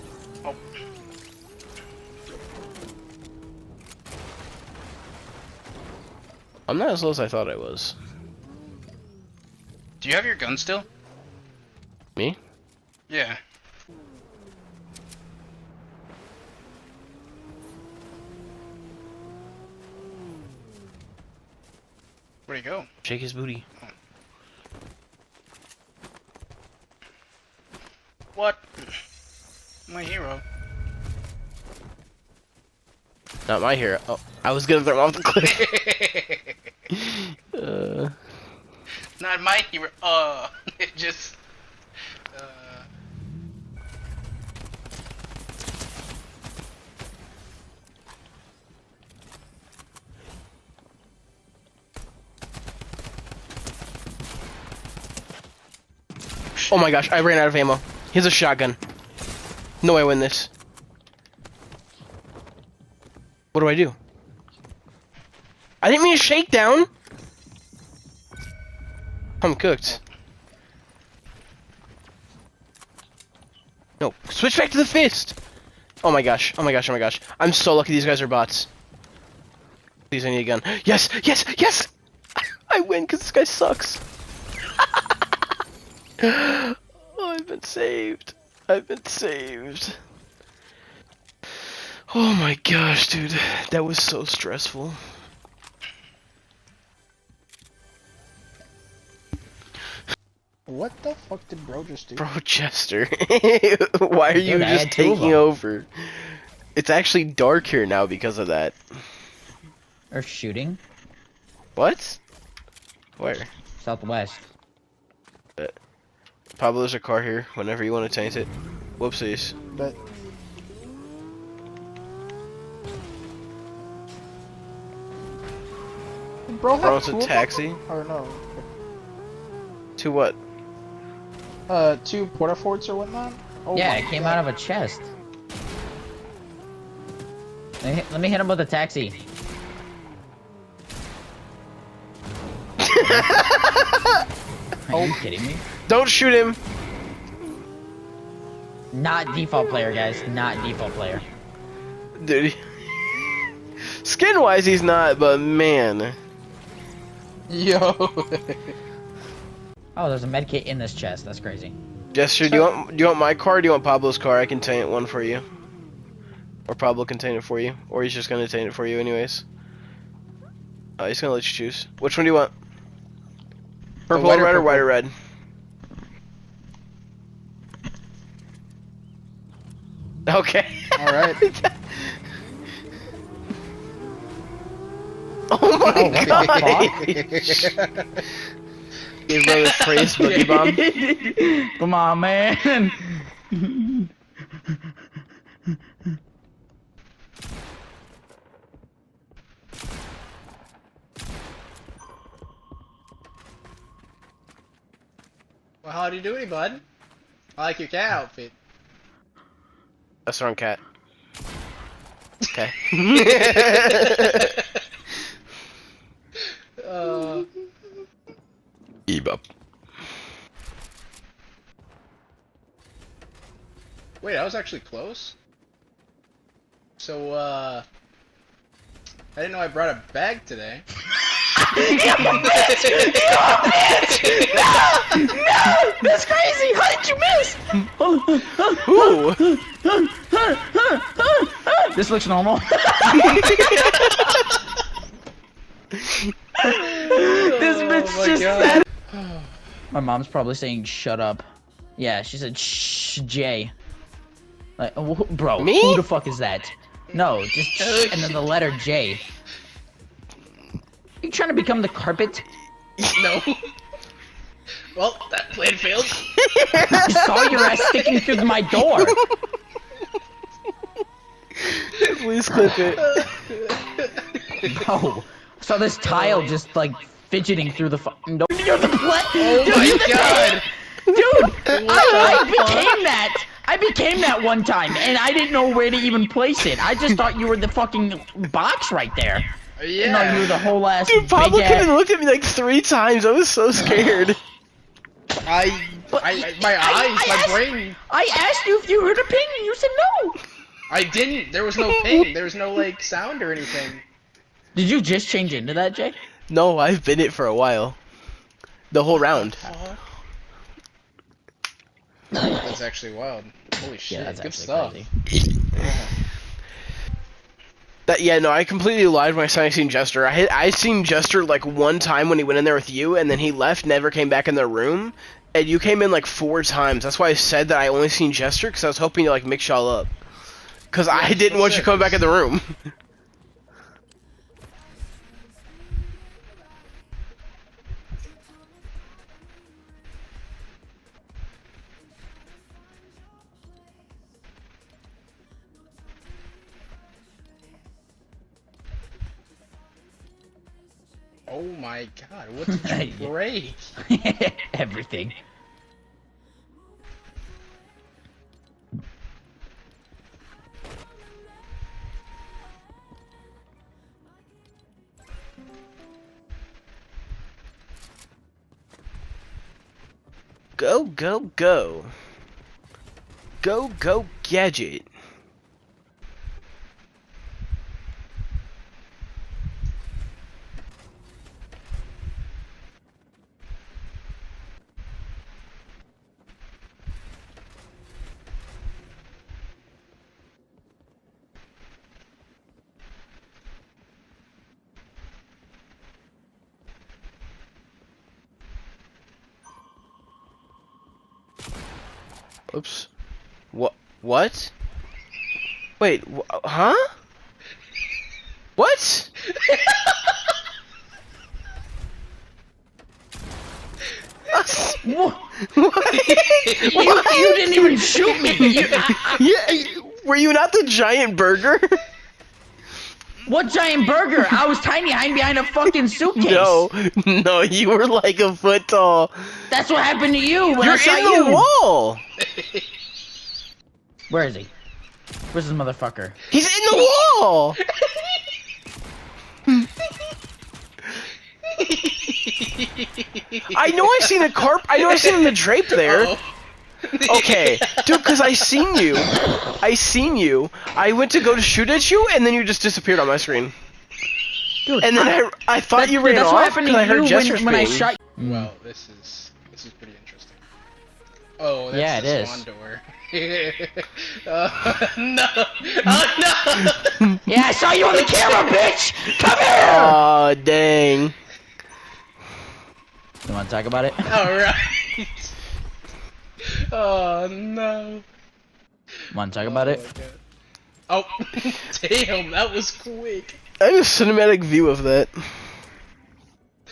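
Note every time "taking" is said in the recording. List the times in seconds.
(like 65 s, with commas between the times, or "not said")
104 s.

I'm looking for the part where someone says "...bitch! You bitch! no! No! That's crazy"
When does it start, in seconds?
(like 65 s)
231 s.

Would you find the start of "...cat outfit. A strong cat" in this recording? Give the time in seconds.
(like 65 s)
207 s.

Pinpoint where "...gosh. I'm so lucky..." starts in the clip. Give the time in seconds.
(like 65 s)
76 s.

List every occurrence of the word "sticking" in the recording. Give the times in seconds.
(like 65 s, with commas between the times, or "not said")
267 s.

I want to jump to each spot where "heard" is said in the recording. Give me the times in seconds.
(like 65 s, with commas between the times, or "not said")
299 s, 457 s.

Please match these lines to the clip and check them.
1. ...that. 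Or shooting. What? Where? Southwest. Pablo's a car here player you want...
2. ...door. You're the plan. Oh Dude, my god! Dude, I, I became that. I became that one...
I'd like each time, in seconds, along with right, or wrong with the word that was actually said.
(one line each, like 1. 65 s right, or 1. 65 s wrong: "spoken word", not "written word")
1. 108 s wrong: "whenever", not "player"
2. 278 s right.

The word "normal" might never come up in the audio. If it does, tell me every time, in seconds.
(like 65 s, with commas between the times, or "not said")
242 s.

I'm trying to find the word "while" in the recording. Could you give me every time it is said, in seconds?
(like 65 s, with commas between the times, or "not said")
307 s.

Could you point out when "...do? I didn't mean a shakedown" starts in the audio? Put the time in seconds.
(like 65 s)
63 s.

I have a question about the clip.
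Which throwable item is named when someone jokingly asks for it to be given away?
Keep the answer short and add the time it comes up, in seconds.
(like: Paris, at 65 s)
Boogie Bomb, at 190 s.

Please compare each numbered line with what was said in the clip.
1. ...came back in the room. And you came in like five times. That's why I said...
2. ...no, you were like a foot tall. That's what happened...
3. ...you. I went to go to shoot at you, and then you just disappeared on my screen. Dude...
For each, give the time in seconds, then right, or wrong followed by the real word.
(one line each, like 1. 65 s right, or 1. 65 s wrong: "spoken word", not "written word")
1. 324 s wrong: "four", not "five"
2. 427 s right
3. 450 s right.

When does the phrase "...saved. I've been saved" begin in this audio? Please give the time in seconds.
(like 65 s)
87 s.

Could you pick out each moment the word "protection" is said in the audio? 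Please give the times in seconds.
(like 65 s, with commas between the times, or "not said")
not said.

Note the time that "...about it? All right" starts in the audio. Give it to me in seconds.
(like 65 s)
473 s.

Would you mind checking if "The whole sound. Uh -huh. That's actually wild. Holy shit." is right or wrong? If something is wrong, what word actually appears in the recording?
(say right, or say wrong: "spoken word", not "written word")
wrong: "round", not "sound".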